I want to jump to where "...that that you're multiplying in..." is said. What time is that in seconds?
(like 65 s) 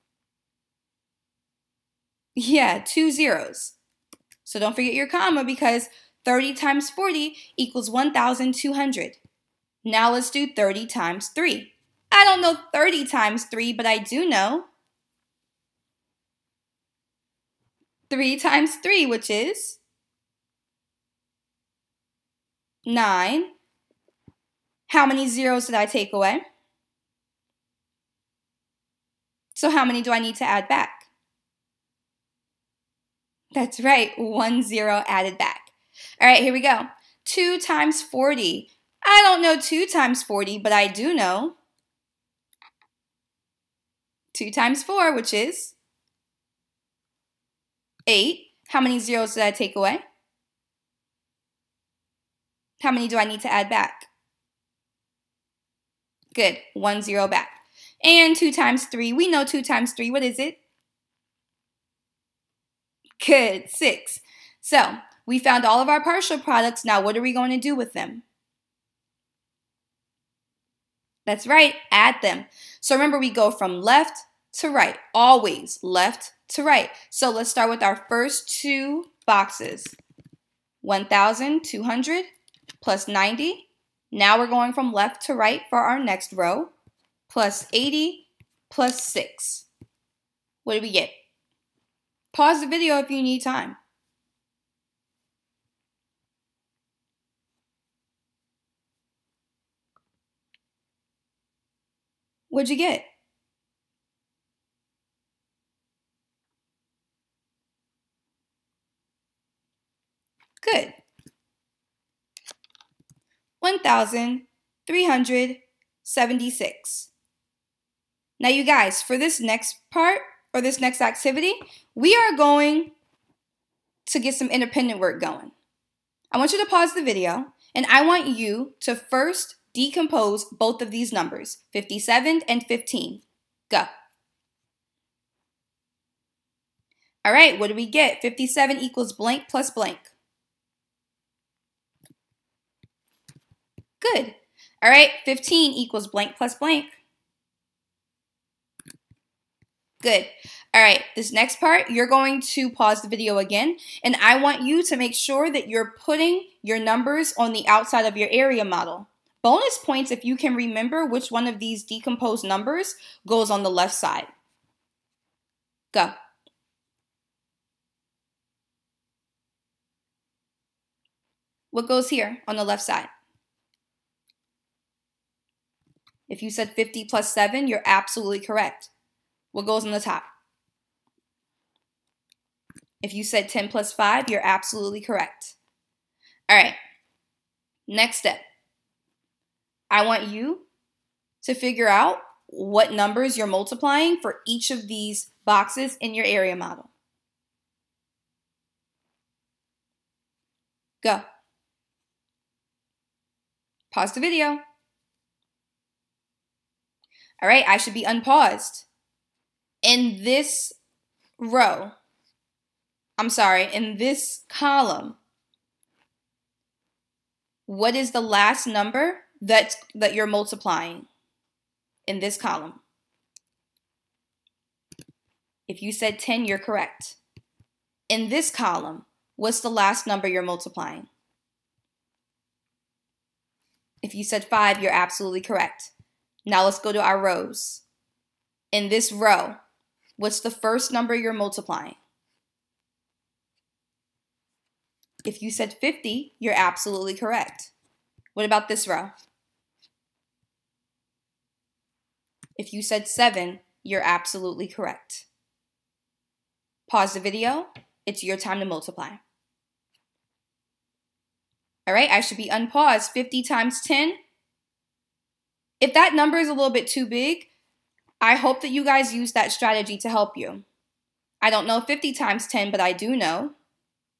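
219 s.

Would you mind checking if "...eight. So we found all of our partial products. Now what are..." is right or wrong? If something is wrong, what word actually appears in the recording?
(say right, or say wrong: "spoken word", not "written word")
wrong: "six", not "eight".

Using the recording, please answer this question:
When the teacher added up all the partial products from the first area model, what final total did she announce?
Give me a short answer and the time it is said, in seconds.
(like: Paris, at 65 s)
1,376, at 113 s.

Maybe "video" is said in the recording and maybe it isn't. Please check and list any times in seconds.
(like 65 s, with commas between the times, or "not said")
92 s, 127 s, 153 s, 204 s, 257 s.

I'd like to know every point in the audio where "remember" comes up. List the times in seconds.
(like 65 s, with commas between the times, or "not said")
72 s, 160 s.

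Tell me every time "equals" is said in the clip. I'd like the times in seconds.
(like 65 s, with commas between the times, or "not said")
7 s, 138 s, 145 s.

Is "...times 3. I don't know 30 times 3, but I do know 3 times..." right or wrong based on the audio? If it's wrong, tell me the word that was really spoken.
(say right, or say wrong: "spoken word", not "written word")
right.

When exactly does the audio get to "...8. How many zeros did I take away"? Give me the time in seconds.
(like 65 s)
48 s.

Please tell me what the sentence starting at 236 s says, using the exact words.
Now let's go to our rows.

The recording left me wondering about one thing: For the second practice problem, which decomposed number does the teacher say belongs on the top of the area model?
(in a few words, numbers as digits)
10 plus 5.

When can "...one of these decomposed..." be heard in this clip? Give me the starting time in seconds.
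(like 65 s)
161 s.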